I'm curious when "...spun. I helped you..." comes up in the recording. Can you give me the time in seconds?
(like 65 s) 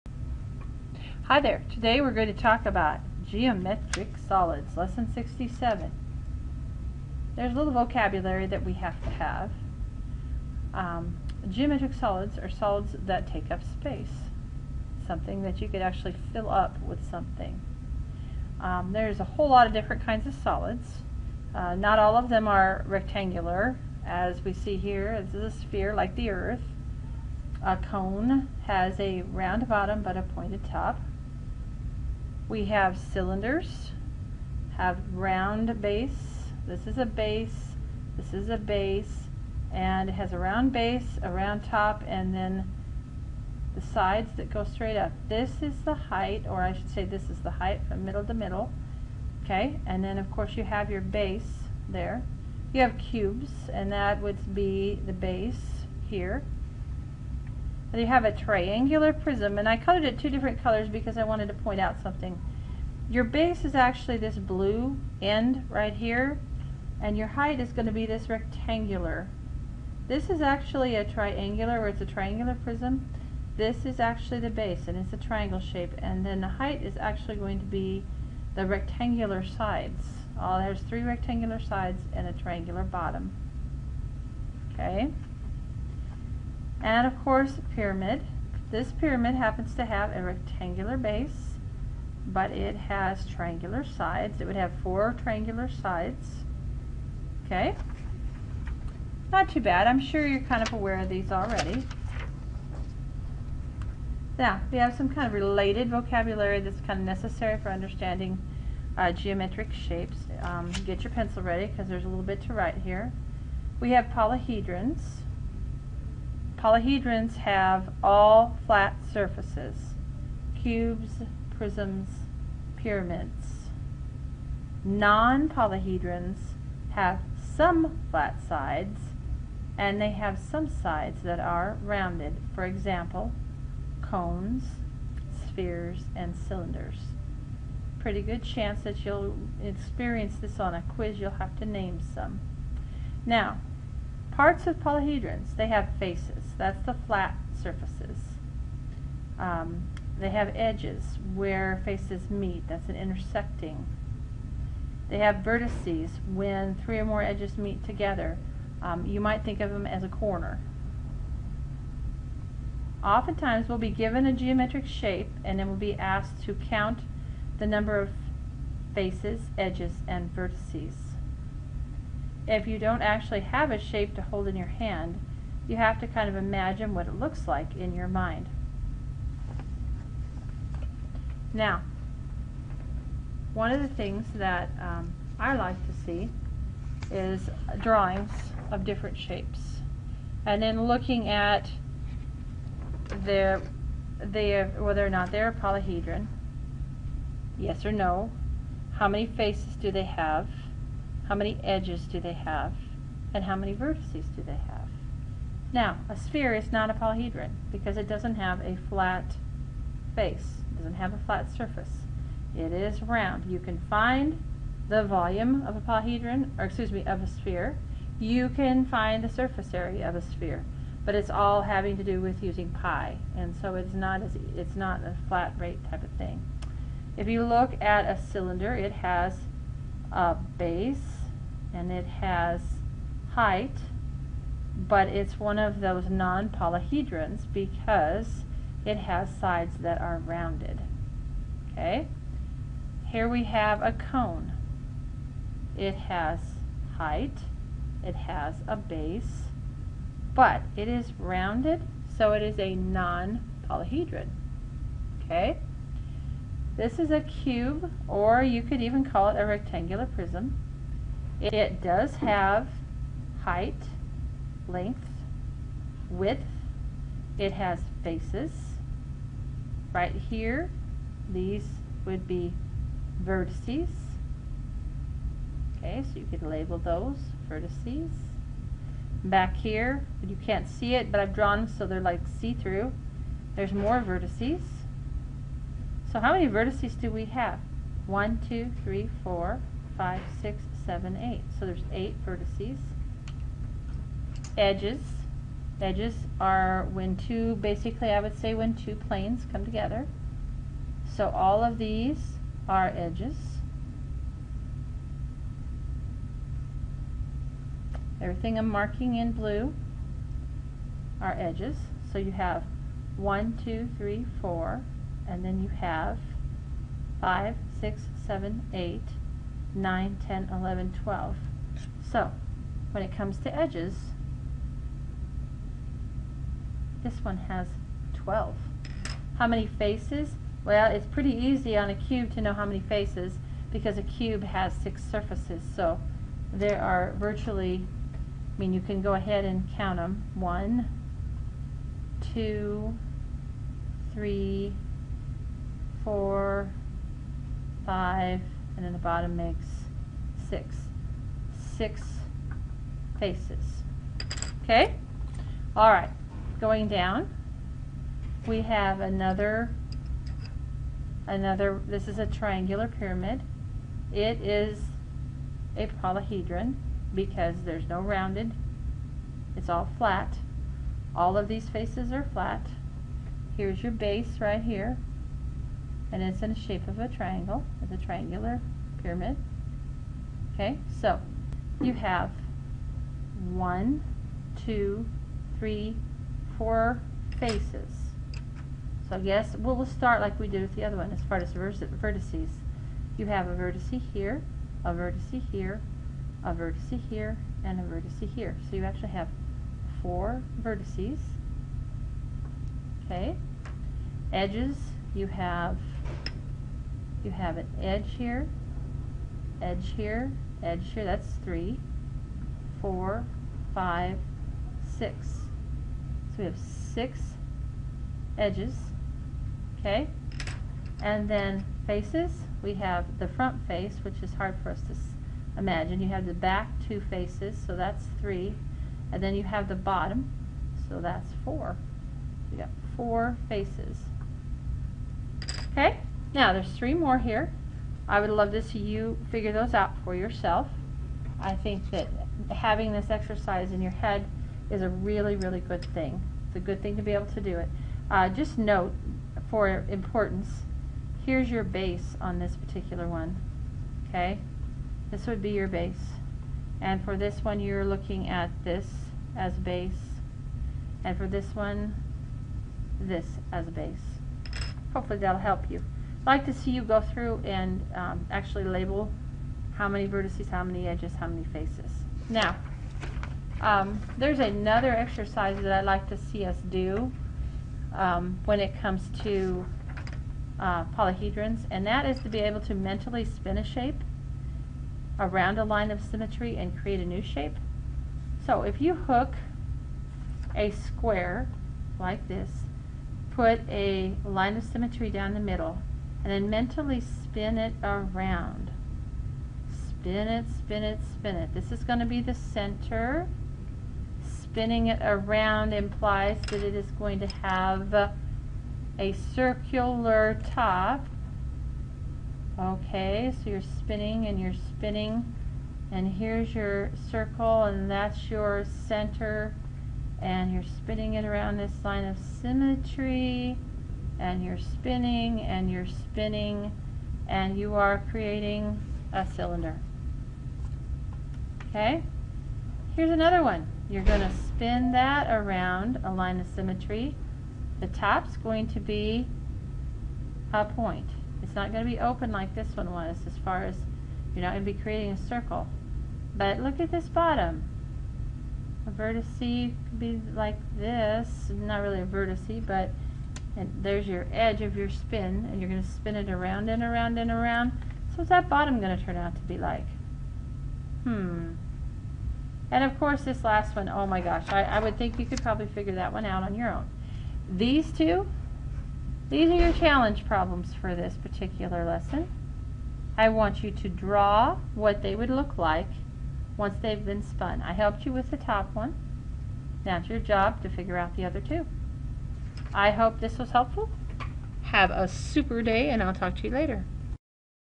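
577 s.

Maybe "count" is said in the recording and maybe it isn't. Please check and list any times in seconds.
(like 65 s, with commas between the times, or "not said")
166 s, 339 s.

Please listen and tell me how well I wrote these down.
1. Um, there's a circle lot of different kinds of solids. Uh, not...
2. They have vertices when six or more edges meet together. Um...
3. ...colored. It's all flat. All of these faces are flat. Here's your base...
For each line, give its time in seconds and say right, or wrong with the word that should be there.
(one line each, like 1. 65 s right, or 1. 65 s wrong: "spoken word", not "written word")
1. 18 s wrong: "whole", not "circle"
2. 155 s wrong: "three", not "six"
3. 367 s wrong: "rounded", not "colored".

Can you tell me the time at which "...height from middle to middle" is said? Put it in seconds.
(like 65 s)
47 s.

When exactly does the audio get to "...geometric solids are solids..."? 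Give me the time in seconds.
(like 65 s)
11 s.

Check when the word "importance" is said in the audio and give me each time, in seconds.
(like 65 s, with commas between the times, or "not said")
449 s.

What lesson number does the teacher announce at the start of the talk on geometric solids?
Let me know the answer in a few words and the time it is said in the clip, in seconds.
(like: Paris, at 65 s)
67, at 4 s.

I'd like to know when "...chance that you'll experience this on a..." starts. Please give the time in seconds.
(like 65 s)
138 s.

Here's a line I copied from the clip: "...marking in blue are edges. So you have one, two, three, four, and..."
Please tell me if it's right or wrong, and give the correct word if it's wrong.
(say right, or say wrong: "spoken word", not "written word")
right.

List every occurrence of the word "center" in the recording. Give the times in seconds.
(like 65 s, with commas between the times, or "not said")
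502 s, 518 s.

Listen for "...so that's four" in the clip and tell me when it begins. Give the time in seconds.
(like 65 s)
430 s.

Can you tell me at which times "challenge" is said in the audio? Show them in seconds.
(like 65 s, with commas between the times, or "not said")
569 s.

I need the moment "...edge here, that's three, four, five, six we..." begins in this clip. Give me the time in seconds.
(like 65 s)
410 s.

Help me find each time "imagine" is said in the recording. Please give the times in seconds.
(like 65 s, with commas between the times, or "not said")
176 s, 425 s.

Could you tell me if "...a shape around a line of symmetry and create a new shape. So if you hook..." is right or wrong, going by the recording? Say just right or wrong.
right.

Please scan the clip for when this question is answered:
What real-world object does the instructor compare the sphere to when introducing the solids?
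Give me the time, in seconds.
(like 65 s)
26 s.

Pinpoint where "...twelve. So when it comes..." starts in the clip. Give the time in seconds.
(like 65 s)
321 s.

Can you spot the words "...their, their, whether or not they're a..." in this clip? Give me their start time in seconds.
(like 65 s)
193 s.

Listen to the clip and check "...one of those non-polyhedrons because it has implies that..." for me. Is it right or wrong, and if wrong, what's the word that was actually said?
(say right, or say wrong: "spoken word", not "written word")
wrong: "sides", not "implies".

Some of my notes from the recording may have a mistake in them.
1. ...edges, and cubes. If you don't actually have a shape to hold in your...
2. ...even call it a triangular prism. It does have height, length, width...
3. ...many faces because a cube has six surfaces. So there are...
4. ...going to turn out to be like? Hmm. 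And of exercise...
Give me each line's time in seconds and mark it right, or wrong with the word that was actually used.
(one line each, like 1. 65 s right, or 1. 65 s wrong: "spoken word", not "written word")
1. 169 s wrong: "vertices", not "cubes"
2. 258 s wrong: "rectangular", not "triangular"
3. 332 s right
4. 558 s wrong: "course", not "exercise".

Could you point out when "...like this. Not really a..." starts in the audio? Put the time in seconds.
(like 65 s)
550 s.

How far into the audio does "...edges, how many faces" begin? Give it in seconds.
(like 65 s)
470 s.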